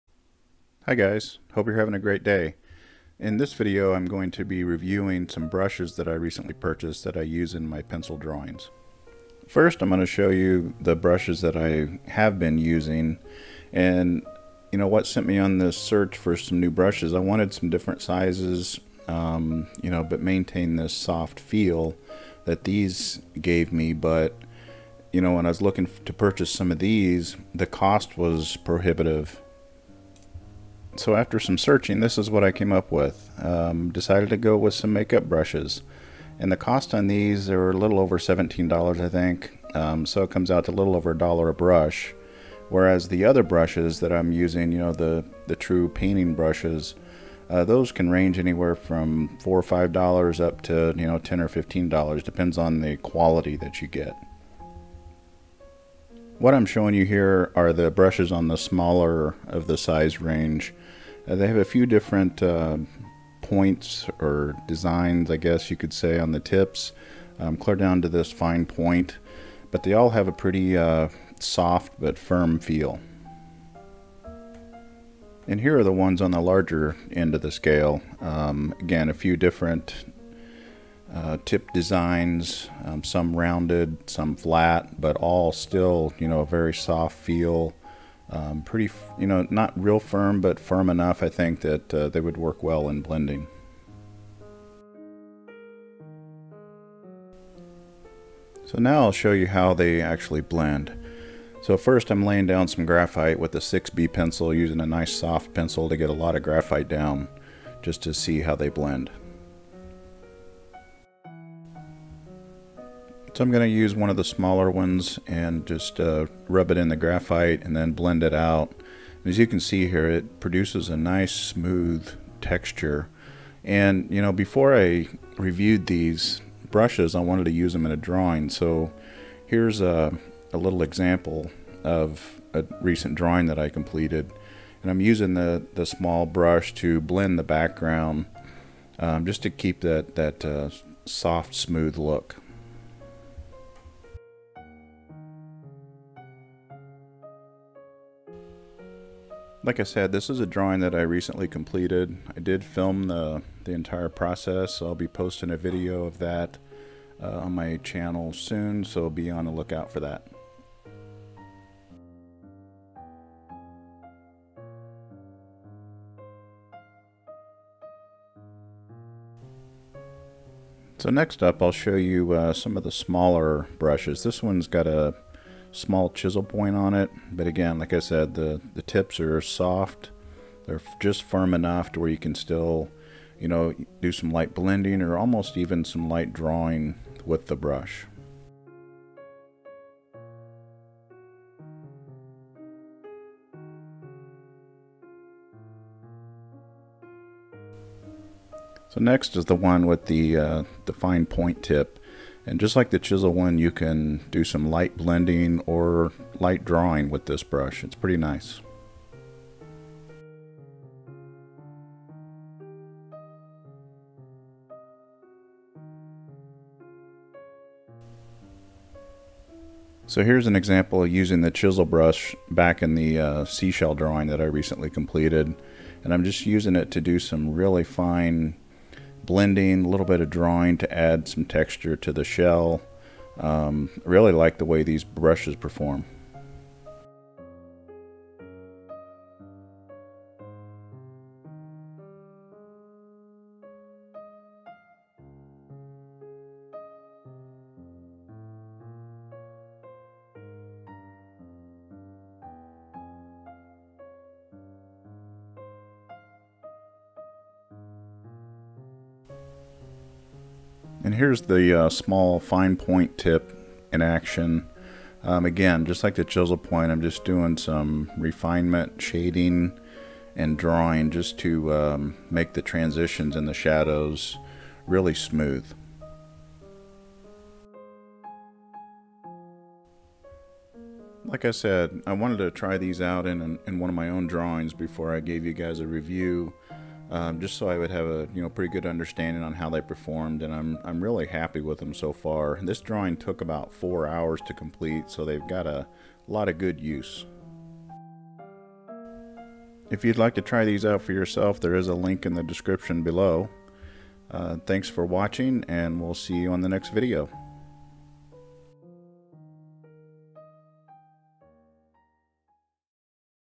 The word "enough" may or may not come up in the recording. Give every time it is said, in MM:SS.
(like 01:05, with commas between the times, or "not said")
01:30, 03:01.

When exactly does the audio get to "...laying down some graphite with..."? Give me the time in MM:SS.
01:42.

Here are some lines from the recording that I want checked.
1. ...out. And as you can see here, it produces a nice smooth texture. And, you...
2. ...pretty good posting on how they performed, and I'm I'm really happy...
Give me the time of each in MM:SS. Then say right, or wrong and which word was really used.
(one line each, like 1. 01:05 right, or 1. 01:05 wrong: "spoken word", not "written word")
1. 01:58 right
2. 04:48 wrong: "understanding", not "posting".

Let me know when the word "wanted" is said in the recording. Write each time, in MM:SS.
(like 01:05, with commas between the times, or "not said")
00:17, 02:07, 04:42.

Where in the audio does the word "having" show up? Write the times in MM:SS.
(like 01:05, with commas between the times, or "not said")
00:01.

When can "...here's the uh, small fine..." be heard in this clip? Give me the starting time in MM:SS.
04:21.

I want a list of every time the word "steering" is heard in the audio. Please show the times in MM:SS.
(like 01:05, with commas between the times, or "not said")
not said.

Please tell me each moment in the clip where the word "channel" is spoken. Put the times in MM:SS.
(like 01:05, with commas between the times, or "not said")
02:37.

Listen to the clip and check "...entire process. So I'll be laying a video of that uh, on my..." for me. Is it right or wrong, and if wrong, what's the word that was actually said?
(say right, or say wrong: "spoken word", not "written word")
wrong: "posting", not "laying".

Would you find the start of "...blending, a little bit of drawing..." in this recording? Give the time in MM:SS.
03:49.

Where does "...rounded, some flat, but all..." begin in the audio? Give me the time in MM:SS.
01:23.